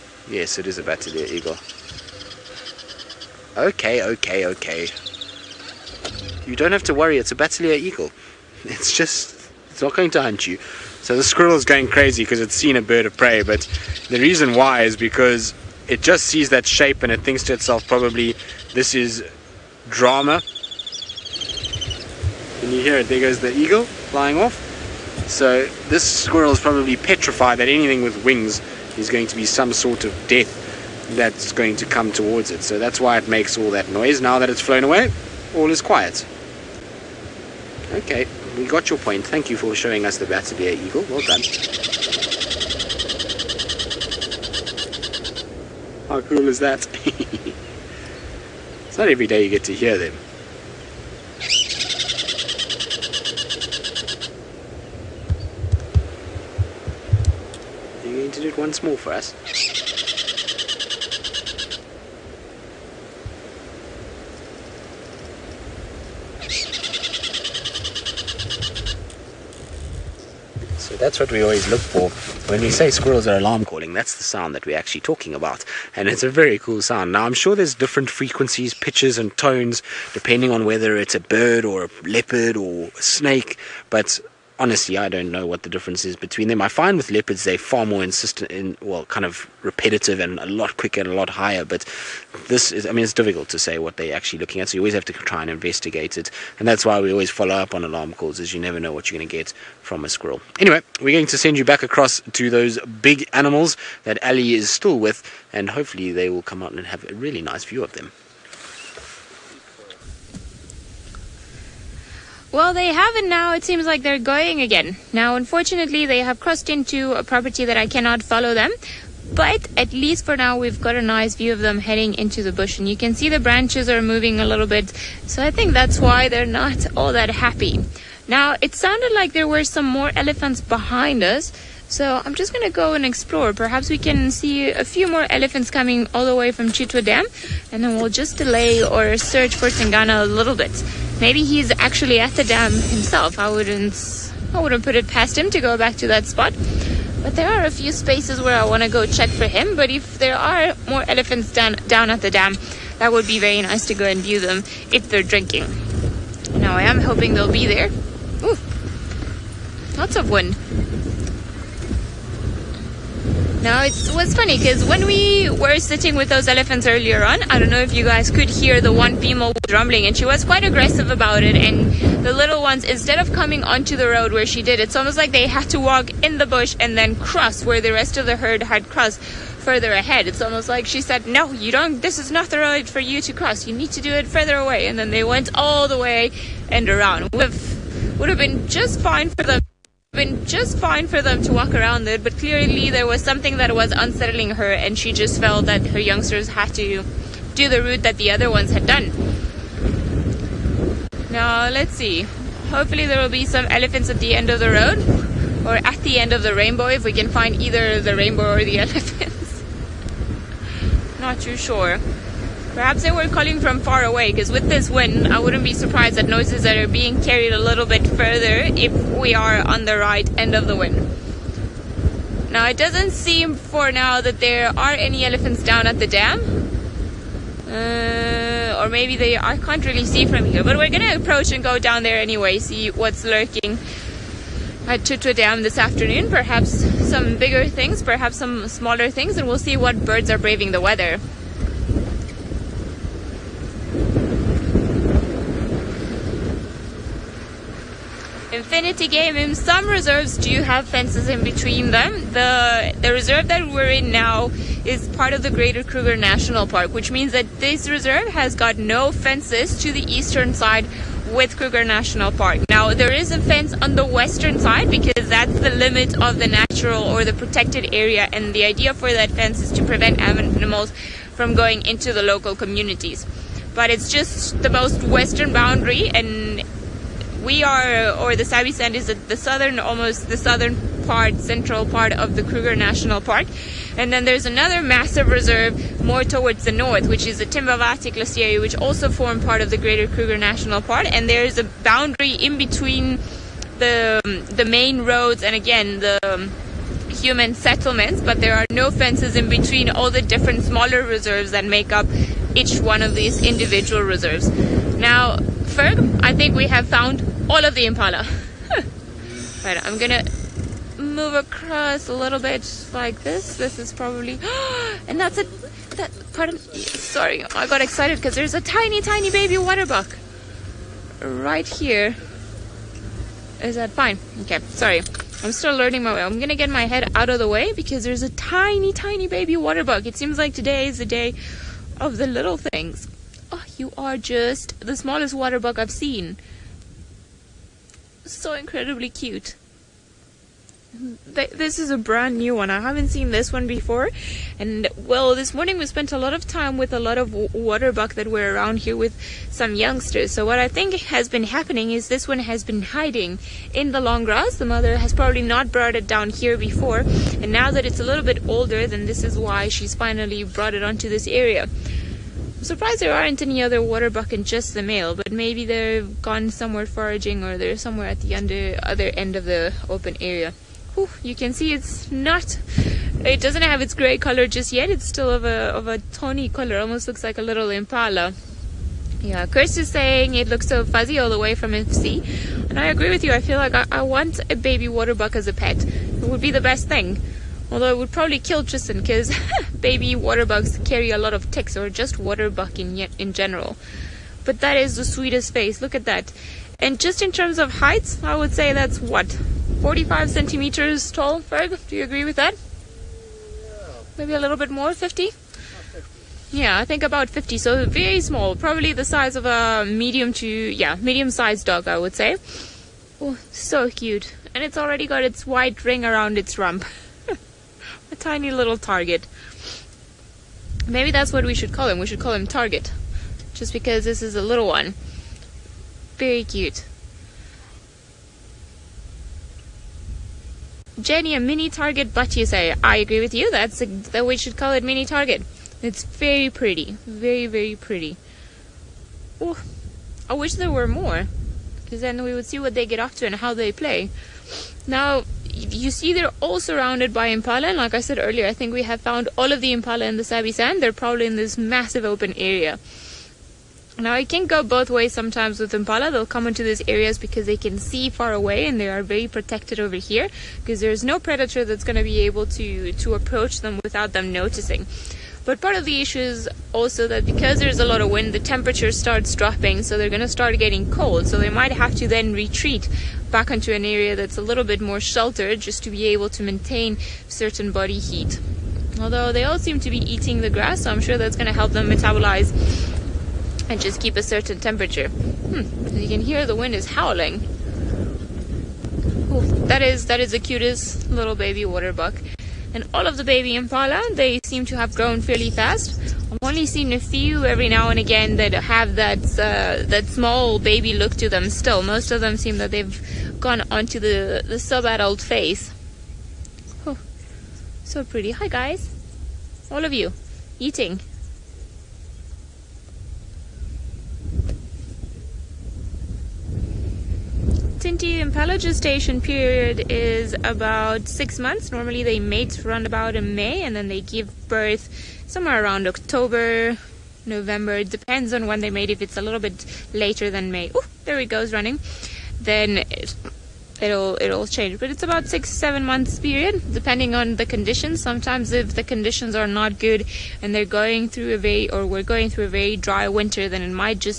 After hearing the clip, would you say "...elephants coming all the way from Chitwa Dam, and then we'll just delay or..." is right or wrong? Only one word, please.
right.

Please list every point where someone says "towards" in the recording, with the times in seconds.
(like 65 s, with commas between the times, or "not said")
32 s, 286 s.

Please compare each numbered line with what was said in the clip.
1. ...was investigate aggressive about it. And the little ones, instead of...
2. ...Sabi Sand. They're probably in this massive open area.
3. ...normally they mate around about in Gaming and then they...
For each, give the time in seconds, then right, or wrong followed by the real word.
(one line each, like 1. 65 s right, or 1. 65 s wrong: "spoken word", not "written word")
1. 170 s wrong: "quite", not "investigate"
2. 450 s right
3. 521 s wrong: "May", not "Gaming".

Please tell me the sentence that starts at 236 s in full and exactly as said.
Perhaps some bigger things, perhaps some smaller things, and we'll see what birds are braving the weather.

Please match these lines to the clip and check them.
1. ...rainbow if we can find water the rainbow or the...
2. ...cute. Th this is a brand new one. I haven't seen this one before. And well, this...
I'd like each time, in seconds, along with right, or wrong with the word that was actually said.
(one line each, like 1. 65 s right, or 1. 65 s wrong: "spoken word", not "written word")
1. 206 s wrong: "either", not "water"
2. 339 s right.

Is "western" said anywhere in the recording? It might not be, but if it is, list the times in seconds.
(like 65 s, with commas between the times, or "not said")
264 s, 275 s.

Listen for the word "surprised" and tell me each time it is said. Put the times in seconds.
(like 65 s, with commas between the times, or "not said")
215 s, 362 s.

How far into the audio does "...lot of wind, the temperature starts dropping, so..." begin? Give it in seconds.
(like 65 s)
467 s.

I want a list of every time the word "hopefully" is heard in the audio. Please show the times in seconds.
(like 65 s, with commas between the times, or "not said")
105 s, 202 s.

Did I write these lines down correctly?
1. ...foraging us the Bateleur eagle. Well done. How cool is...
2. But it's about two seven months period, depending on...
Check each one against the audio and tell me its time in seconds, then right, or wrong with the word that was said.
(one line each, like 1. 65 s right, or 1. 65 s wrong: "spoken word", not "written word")
1. 39 s wrong: "showing", not "foraging"
2. 534 s wrong: "six", not "two".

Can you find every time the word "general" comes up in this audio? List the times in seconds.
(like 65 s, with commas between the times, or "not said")
393 s.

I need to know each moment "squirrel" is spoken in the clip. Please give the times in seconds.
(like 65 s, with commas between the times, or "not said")
11 s, 26 s, 72 s, 100 s.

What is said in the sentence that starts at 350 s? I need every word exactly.
So what I think has been happening is this one has been hiding in the long grass.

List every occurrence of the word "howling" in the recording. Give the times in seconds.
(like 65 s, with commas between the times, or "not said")
486 s.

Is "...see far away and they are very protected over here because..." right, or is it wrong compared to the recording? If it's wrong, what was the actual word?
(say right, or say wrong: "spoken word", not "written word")
right.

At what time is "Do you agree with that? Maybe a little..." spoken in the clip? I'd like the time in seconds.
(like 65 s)
401 s.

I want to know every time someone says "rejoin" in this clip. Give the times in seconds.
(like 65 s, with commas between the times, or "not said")
not said.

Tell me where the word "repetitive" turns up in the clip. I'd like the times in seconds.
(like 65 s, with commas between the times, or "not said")
89 s.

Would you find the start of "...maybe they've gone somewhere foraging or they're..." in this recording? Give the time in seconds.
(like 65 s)
365 s.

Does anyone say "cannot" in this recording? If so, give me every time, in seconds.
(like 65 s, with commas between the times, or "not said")
117 s.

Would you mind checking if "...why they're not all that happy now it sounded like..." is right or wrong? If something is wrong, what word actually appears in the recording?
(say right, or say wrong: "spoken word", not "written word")
right.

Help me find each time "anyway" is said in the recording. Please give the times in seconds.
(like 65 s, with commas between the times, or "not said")
100 s, 232 s.